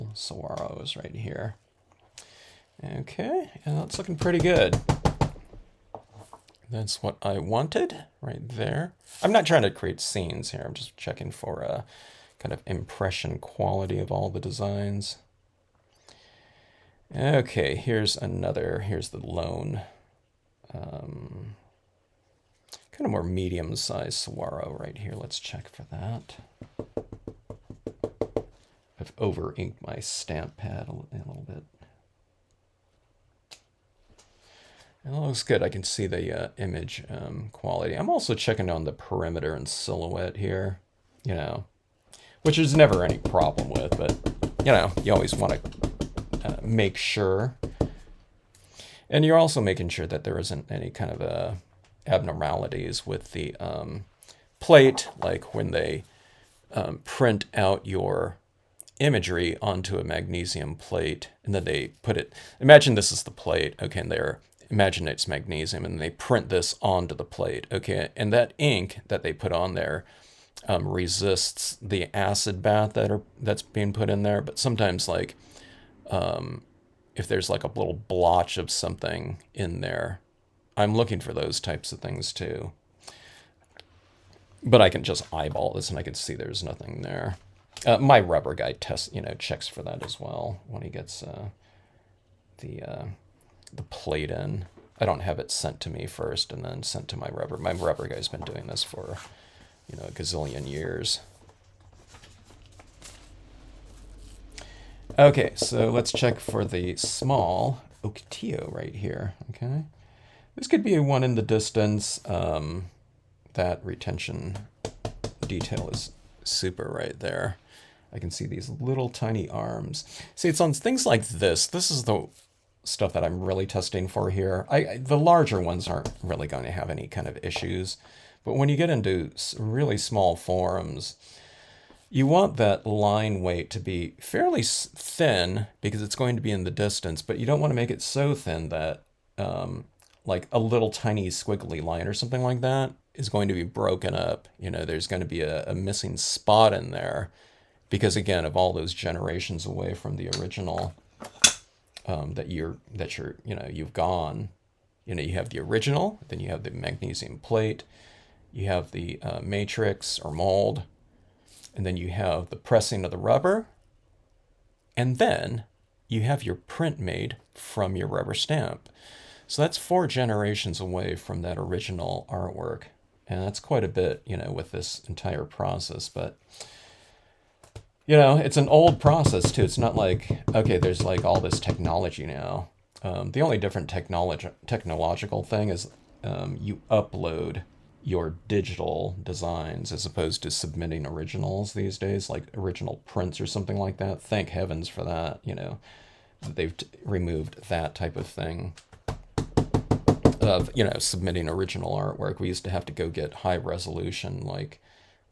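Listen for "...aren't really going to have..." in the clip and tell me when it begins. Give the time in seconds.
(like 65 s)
125 s.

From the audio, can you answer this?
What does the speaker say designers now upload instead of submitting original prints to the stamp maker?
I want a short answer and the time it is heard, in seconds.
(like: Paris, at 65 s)
Digital designs, at 188 s.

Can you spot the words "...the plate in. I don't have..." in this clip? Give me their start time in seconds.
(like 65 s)
93 s.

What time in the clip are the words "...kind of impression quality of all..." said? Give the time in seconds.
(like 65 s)
12 s.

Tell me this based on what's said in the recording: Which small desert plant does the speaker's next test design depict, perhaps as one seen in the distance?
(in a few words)
Ocotillo.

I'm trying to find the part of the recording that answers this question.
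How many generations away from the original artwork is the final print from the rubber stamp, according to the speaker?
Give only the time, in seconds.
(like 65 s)
169 s.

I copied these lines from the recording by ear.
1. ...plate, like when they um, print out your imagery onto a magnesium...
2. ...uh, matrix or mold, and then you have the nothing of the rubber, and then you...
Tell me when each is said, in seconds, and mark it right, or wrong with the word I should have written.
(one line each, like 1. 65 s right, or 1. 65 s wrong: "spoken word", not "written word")
1. 54 s right
2. 159 s wrong: "pressing", not "nothing".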